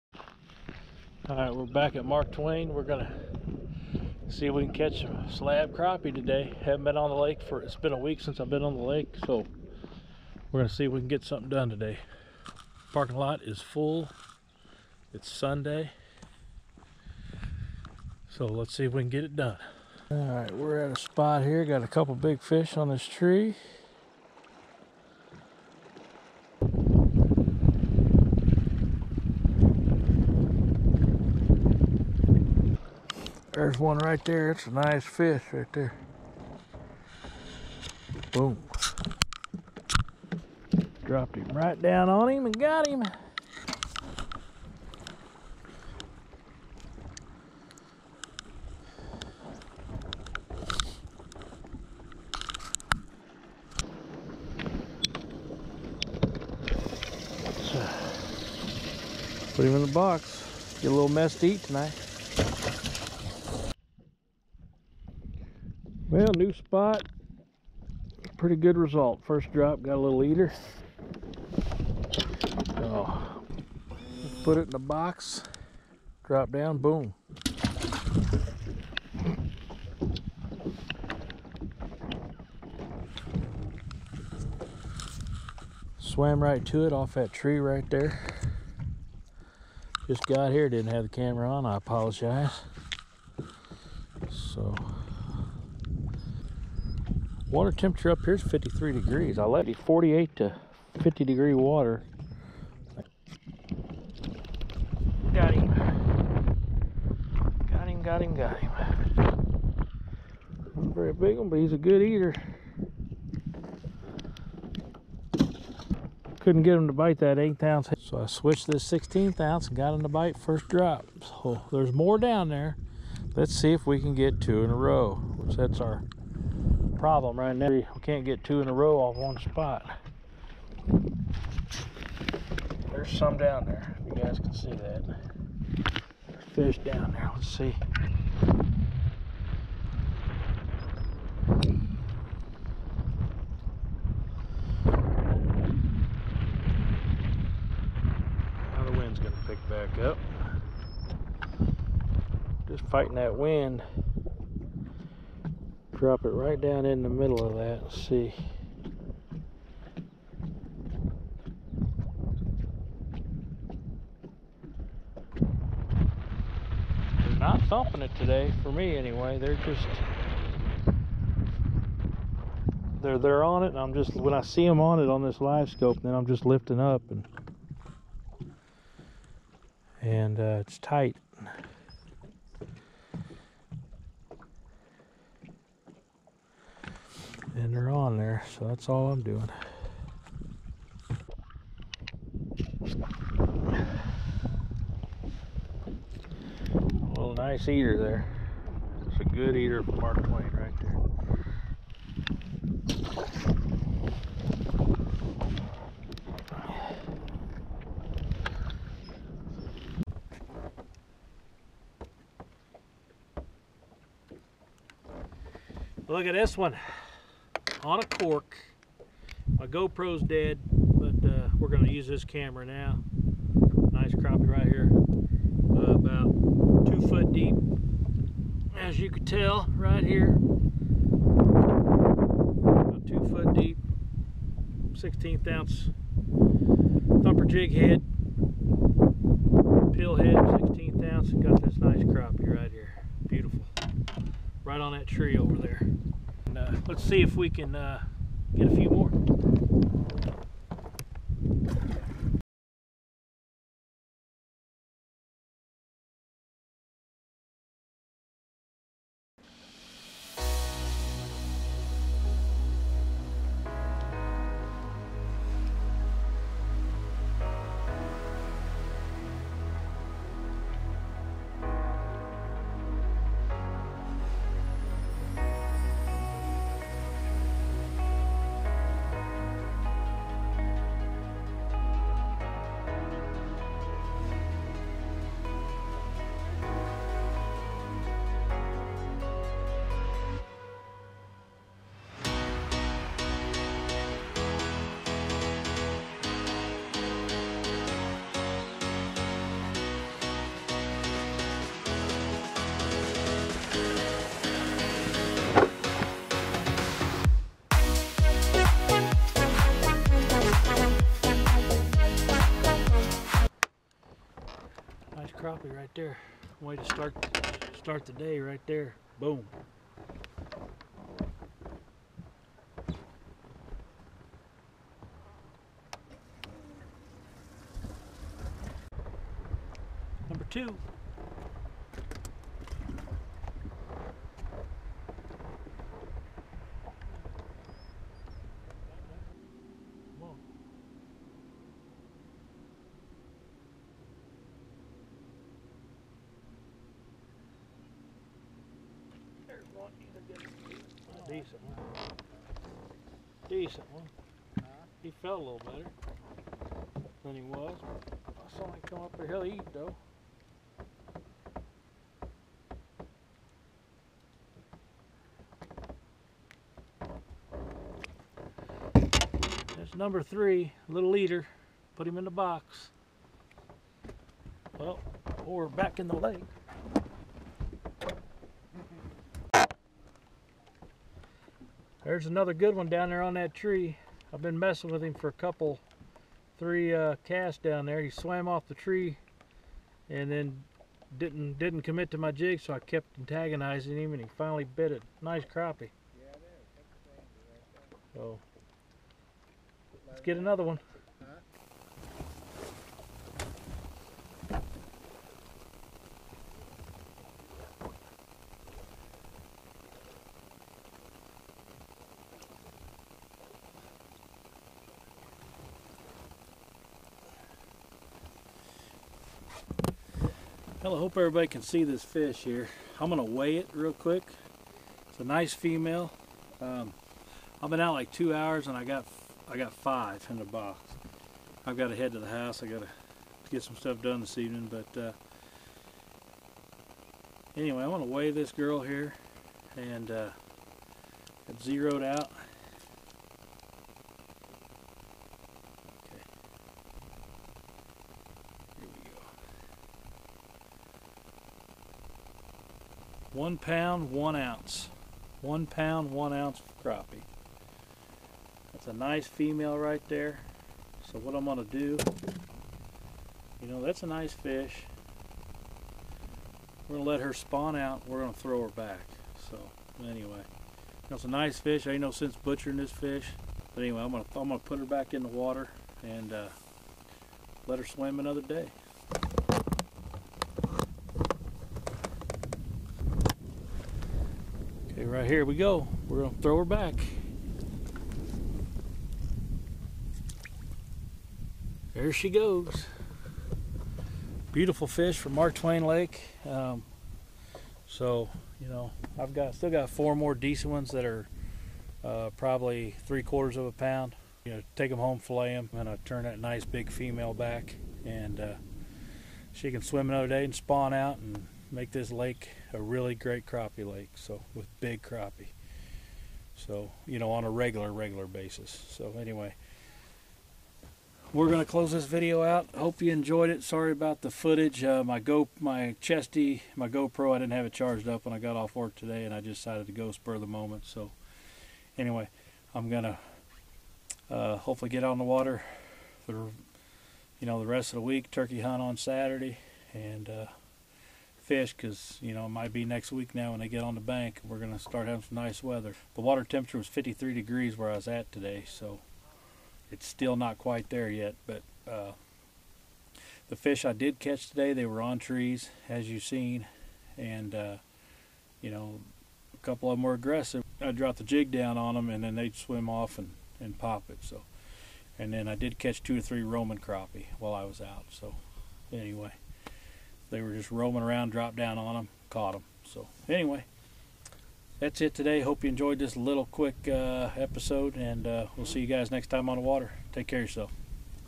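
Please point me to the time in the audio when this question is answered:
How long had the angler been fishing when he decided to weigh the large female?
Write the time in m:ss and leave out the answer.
7:08.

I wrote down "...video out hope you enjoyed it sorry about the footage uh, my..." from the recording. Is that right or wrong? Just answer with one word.
right.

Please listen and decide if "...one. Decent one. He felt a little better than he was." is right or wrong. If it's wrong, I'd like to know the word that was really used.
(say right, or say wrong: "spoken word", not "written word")
right.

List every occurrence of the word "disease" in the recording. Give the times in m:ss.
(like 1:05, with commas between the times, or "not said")
not said.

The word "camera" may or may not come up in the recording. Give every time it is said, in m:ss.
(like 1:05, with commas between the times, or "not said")
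1:31, 3:42.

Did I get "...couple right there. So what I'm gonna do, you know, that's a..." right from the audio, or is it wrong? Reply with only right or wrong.
wrong.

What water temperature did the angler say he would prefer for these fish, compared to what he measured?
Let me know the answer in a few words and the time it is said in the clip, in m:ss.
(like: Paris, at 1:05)
48 to 50 degrees, at 1:39.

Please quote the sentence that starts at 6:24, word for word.
I've been messing with him for a couple, three uh, casts down there.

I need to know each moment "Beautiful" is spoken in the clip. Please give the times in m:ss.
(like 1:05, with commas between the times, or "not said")
4:03, 8:14.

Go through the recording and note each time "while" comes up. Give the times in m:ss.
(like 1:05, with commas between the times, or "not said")
9:27.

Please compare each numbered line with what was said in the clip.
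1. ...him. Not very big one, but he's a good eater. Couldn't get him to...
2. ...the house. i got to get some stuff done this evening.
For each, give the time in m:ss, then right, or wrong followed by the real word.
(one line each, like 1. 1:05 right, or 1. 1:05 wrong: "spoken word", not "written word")
1. 1:48 right
2. 7:12 right.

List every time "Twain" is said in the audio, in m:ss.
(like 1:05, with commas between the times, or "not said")
0:02, 3:20, 8:15.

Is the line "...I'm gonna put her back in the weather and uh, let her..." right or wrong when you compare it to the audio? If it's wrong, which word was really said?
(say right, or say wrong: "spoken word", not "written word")
wrong: "water", not "weather".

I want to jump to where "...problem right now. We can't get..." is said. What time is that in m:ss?
2:07.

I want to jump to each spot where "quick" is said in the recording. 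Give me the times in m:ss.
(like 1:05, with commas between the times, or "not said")
7:03, 9:36.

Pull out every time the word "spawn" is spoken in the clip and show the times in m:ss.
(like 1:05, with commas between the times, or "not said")
7:47, 8:30.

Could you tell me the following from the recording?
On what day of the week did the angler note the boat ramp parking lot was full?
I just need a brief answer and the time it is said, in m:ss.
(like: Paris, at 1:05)
Sunday, at 0:15.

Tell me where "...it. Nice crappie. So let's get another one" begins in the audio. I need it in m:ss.
6:34.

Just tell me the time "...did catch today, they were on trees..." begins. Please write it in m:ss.
9:13.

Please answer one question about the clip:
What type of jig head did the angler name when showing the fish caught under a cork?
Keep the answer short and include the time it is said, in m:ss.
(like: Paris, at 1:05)
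thumper jig head, at 3:57.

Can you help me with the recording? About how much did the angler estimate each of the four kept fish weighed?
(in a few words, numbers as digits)
3/4 pound.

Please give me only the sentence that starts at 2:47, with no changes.
They're not thumping it today, for me anyway.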